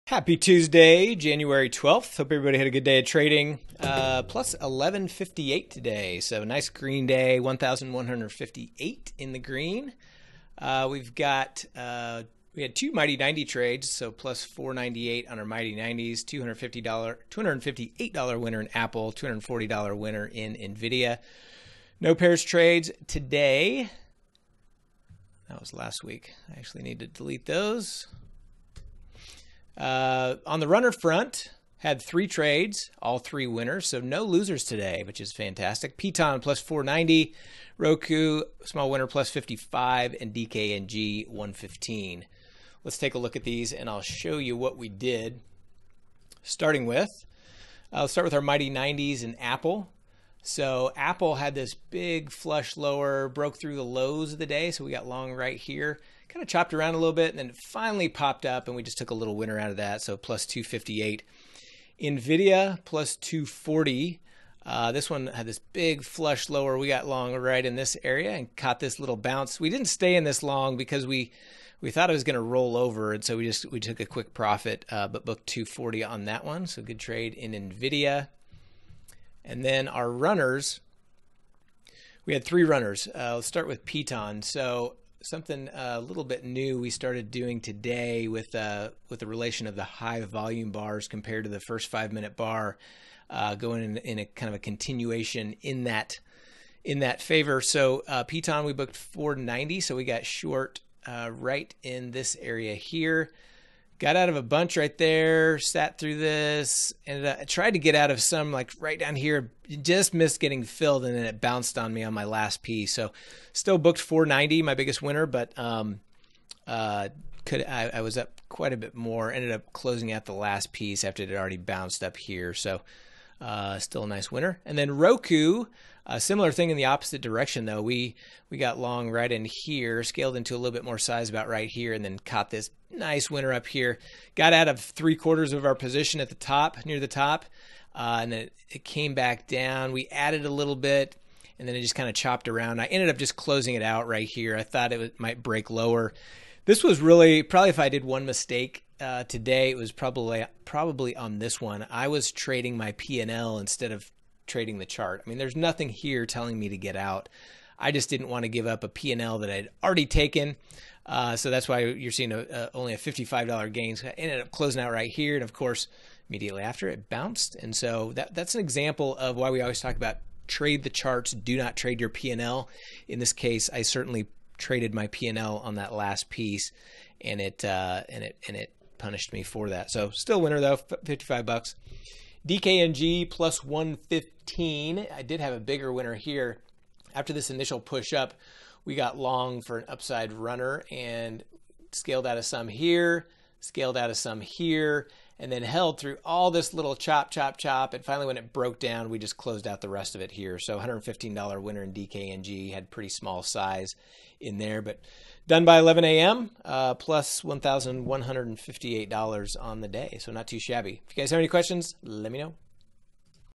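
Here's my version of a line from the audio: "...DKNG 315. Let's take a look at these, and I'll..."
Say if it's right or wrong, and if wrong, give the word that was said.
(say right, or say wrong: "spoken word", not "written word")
wrong: "115", not "315".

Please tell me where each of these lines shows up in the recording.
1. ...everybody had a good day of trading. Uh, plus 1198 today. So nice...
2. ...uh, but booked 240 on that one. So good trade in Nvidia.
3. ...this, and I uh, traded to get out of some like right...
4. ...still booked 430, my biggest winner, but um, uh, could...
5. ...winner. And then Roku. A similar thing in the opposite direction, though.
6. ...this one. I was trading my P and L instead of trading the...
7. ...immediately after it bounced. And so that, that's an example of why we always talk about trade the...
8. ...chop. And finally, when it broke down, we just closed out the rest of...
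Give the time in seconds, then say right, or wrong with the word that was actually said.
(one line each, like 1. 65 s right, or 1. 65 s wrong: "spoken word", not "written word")
1. 2 s wrong: "1158", not "1198"
2. 74 s right
3. 106 s wrong: "tried", not "traded"
4. 113 s wrong: "490", not "430"
5. 124 s right
6. 151 s right
7. 166 s right
8. 197 s right.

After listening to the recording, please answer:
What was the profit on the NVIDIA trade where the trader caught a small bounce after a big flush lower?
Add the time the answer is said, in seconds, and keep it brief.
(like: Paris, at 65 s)
$240, at 62 s.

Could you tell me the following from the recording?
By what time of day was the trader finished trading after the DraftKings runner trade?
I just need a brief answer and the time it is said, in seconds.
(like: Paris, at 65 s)
11 a.m., at 205 s.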